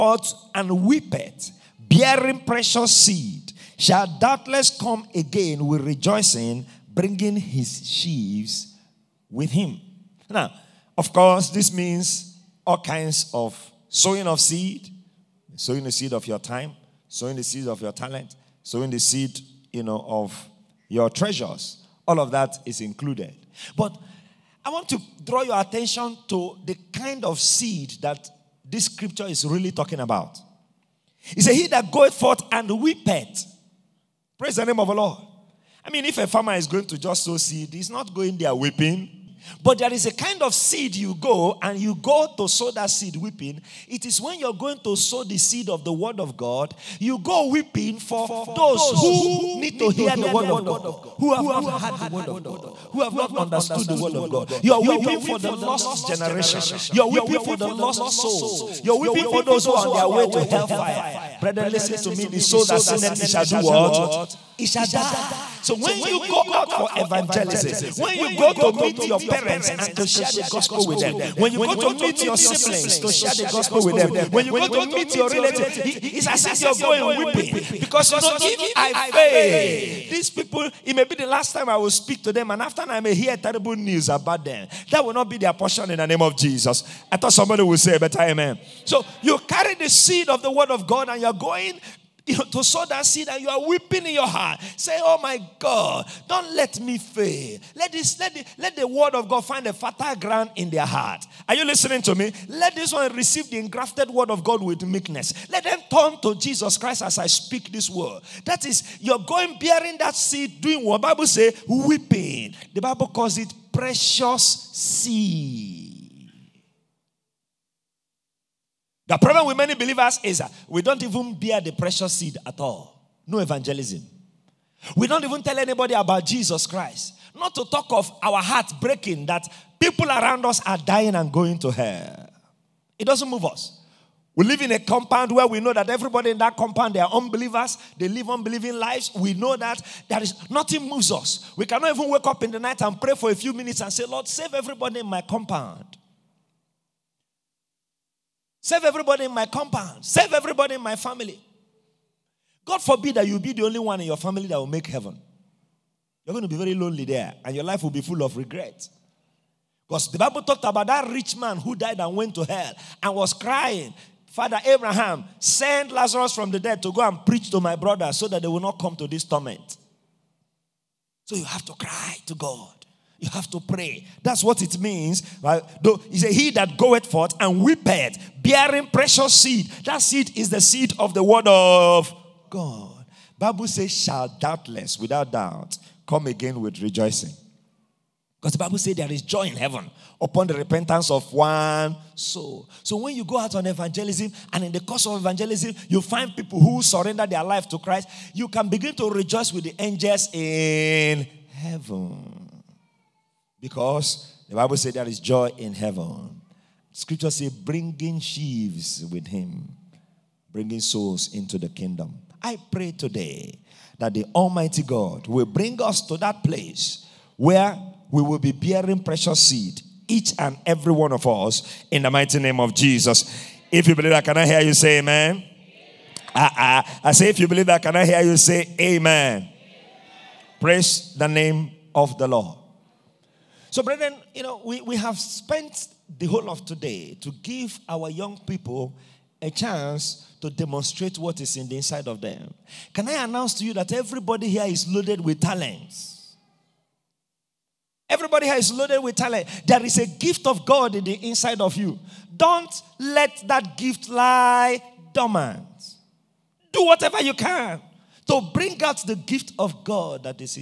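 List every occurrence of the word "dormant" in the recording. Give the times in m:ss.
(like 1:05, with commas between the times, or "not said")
4:15.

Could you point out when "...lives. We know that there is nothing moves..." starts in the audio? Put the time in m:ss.
2:18.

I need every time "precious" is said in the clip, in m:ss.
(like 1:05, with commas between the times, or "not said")
0:02, 1:53, 2:01, 2:58, 3:39.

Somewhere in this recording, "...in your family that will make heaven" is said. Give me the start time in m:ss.
2:33.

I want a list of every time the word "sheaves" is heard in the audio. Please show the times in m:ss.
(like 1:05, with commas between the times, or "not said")
0:07, 3:28.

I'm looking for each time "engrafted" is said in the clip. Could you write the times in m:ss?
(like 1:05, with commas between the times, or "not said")
1:43.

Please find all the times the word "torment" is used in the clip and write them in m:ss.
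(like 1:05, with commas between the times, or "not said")
2:49.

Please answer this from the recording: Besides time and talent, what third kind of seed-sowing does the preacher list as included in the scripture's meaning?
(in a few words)
Treasures.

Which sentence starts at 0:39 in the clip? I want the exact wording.
But there is a kind of seed you go and you go to sow that seed weeping.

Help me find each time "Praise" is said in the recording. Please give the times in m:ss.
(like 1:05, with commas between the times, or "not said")
0:34, 3:50.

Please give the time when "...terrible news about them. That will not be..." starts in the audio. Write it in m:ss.
1:23.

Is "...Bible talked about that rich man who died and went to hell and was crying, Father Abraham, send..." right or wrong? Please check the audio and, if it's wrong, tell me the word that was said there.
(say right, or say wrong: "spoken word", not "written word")
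right.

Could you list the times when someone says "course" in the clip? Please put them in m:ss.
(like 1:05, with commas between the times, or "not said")
0:11, 3:14.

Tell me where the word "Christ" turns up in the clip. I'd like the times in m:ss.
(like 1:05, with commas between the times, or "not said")
1:46, 2:06, 3:17.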